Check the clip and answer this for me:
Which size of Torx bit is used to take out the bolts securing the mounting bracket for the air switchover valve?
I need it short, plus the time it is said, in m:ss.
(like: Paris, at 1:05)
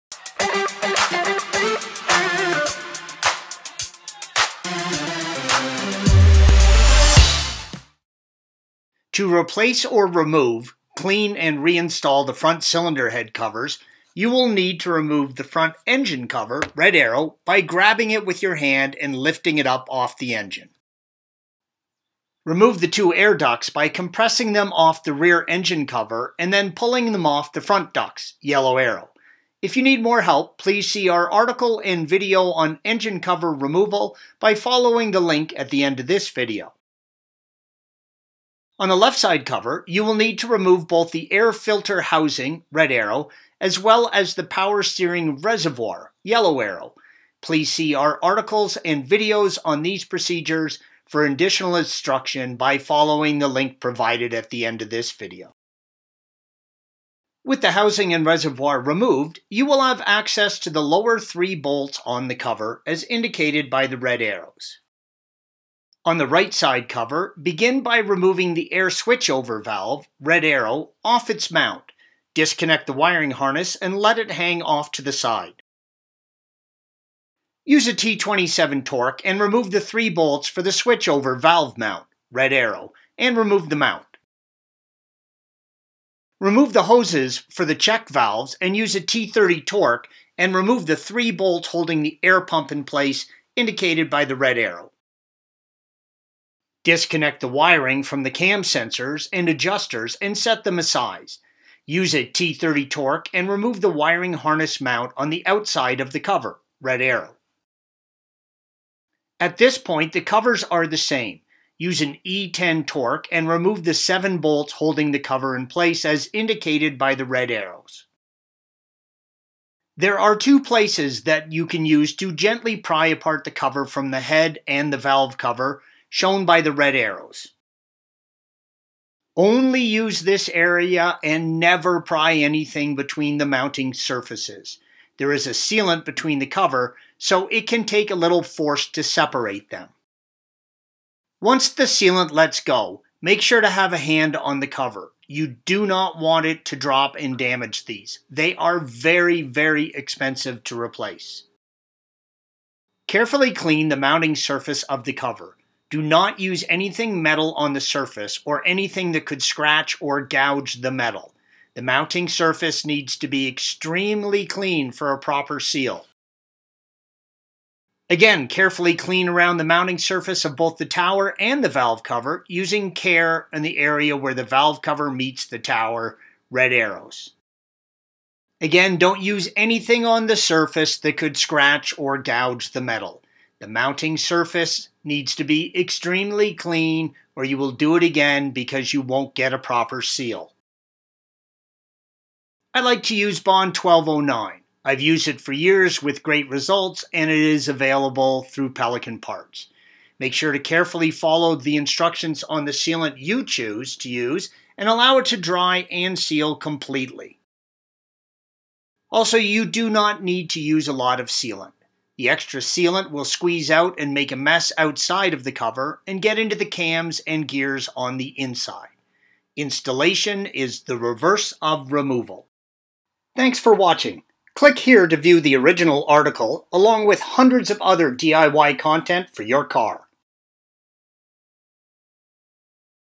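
T27, at 1:17.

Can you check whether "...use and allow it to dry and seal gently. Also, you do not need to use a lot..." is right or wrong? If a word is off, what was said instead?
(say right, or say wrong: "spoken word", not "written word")
wrong: "completely", not "gently".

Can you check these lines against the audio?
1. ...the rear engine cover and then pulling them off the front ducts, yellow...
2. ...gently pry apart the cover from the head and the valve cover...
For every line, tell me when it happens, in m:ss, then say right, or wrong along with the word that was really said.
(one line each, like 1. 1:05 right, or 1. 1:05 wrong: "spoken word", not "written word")
1. 0:25 right
2. 2:02 right.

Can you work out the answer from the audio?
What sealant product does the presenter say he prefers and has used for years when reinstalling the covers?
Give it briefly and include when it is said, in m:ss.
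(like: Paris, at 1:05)
Bond 1209, at 3:13.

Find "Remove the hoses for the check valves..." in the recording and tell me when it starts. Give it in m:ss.
1:26.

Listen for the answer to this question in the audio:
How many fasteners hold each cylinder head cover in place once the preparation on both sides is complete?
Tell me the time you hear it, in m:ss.
1:53.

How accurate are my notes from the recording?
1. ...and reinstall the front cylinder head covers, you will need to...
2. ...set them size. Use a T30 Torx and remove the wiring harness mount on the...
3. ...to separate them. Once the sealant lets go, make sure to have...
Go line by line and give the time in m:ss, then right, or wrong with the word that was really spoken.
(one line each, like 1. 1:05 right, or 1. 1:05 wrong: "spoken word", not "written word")
1. 0:11 right
2. 1:40 right
3. 2:18 right.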